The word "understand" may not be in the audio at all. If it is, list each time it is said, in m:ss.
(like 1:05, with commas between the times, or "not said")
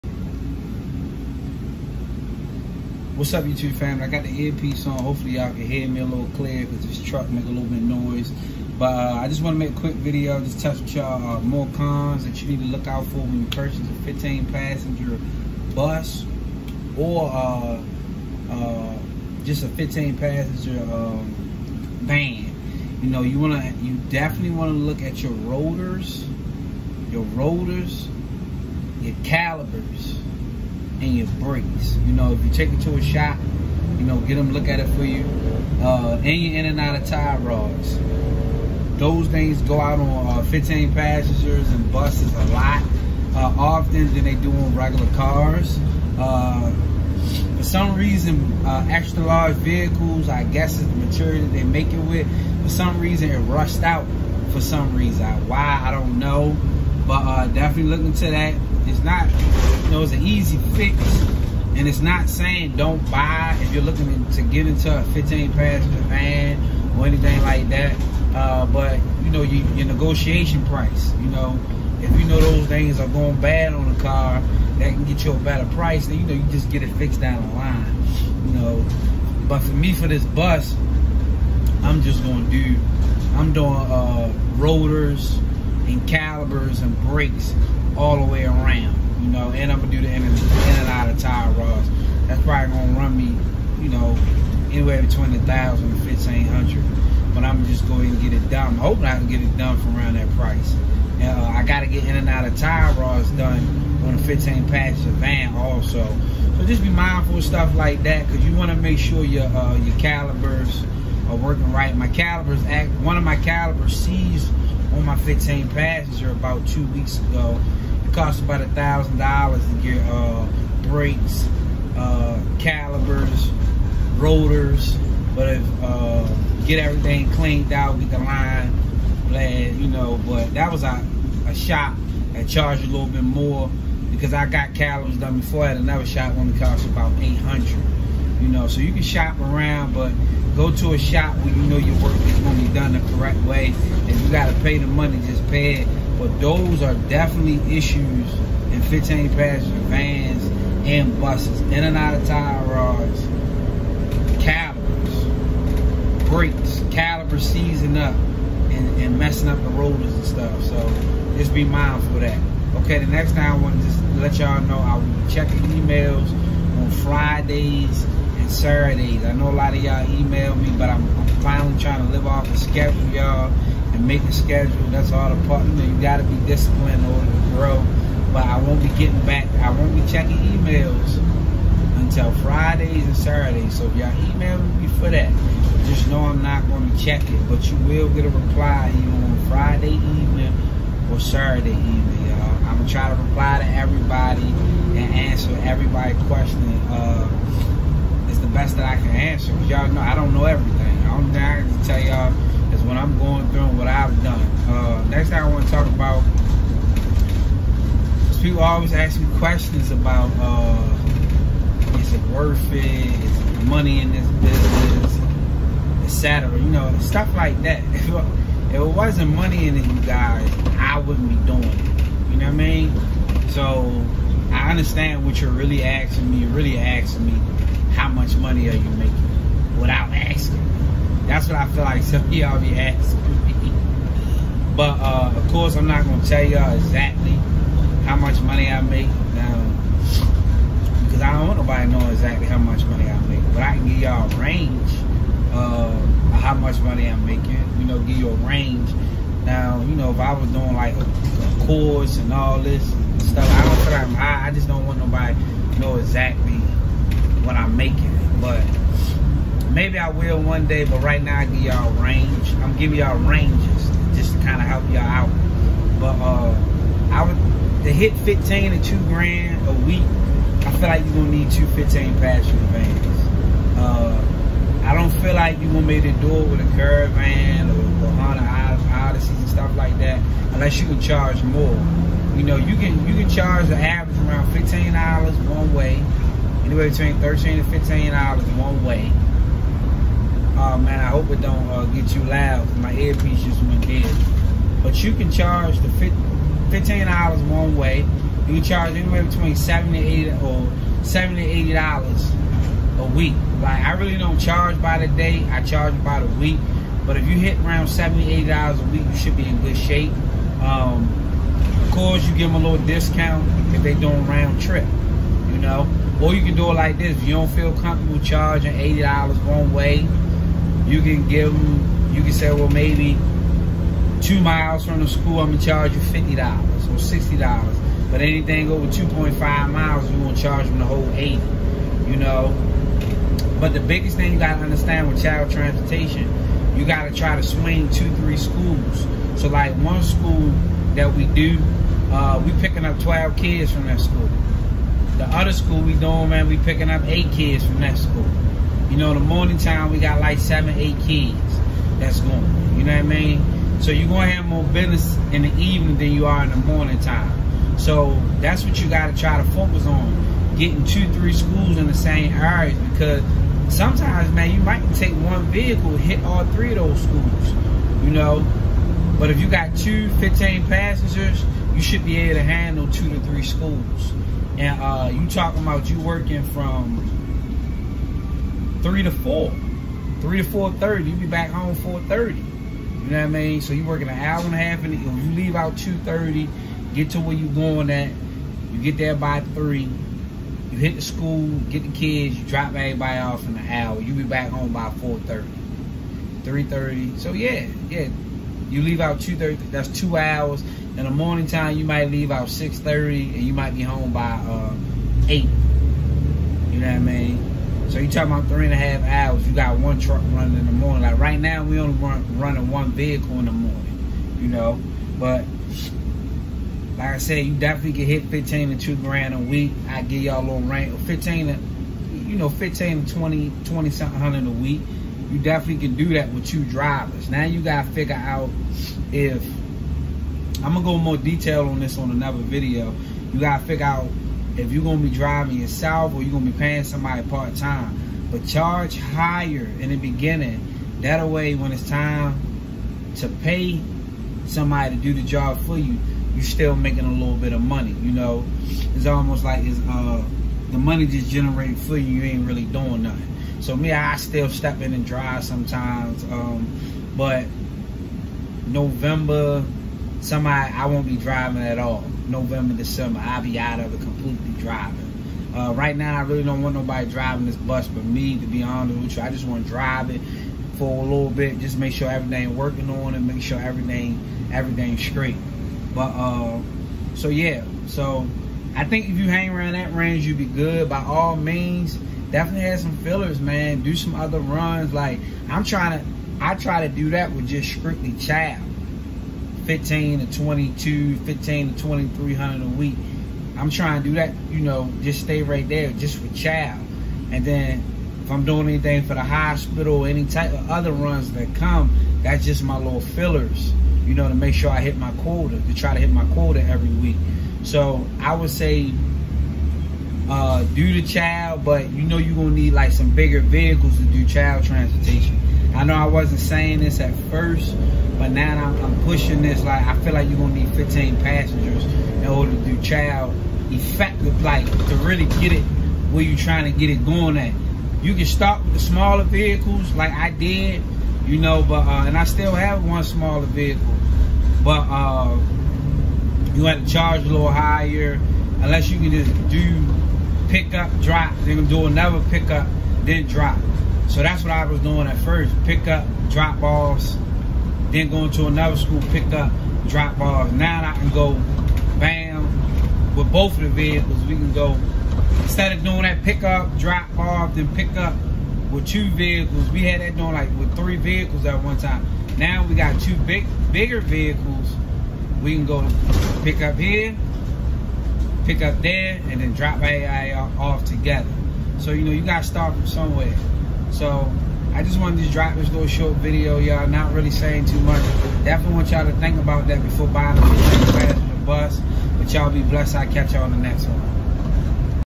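3:44, 5:34.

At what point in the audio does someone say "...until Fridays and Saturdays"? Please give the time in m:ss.
3:01.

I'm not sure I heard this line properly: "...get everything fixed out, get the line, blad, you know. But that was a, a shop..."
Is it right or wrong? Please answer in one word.
wrong.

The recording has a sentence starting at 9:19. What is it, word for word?
We had that doing like with three vehicles at one time.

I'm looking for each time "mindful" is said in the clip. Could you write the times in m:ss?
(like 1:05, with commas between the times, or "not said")
1:46, 2:41.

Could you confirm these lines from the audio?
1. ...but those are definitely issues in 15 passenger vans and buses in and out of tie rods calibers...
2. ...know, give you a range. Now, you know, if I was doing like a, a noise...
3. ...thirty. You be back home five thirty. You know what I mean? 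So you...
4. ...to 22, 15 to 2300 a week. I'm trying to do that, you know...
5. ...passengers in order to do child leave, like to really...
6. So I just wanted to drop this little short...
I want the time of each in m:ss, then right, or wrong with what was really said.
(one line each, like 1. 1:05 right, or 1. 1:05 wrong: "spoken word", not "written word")
1. 2:26 right
2. 4:07 wrong: "course", not "noise"
3. 6:20 wrong: "four", not "five"
4. 8:10 right
5. 8:41 wrong: "effective", not "leave"
6. 9:33 right.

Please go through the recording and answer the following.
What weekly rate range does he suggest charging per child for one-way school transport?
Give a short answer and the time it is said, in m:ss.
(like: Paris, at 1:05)
$70 to $80, at 5:01.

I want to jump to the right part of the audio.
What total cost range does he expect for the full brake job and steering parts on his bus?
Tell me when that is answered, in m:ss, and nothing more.
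1:34.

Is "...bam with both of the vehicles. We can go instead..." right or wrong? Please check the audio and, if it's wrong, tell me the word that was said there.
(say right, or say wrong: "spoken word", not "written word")
right.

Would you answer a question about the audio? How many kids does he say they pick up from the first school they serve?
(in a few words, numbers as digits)
12.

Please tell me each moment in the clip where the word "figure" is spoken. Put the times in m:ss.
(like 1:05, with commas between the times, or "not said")
7:07, 7:13.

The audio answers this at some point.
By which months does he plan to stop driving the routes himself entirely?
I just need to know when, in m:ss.
7:42.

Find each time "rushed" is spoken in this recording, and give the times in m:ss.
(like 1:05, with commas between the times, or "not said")
0:53.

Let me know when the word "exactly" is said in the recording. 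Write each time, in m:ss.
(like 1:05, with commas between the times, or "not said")
3:56, 4:02, 4:15.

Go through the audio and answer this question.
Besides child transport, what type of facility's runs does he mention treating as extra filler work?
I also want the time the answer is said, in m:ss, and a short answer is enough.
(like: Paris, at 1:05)
Hospital, at 8:19.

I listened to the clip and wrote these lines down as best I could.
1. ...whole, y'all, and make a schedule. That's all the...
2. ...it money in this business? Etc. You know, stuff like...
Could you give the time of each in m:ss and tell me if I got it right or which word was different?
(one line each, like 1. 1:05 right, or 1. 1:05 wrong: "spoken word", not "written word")
1. 2:52 wrong: "schedule", not "whole"
2. 3:33 right.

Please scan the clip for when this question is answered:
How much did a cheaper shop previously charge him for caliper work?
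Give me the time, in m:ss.
2:16.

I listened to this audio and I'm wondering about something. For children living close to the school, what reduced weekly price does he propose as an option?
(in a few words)
$50 or $60.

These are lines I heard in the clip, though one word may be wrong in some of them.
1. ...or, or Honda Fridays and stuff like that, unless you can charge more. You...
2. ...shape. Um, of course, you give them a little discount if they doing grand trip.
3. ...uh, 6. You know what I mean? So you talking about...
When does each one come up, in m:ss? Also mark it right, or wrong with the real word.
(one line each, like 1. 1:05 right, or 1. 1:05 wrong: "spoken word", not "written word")
1. 4:37 wrong: "Odyssey", not "Fridays"
2. 5:09 wrong: "round", not "grand"
3. 6:44 wrong: "8", not "6".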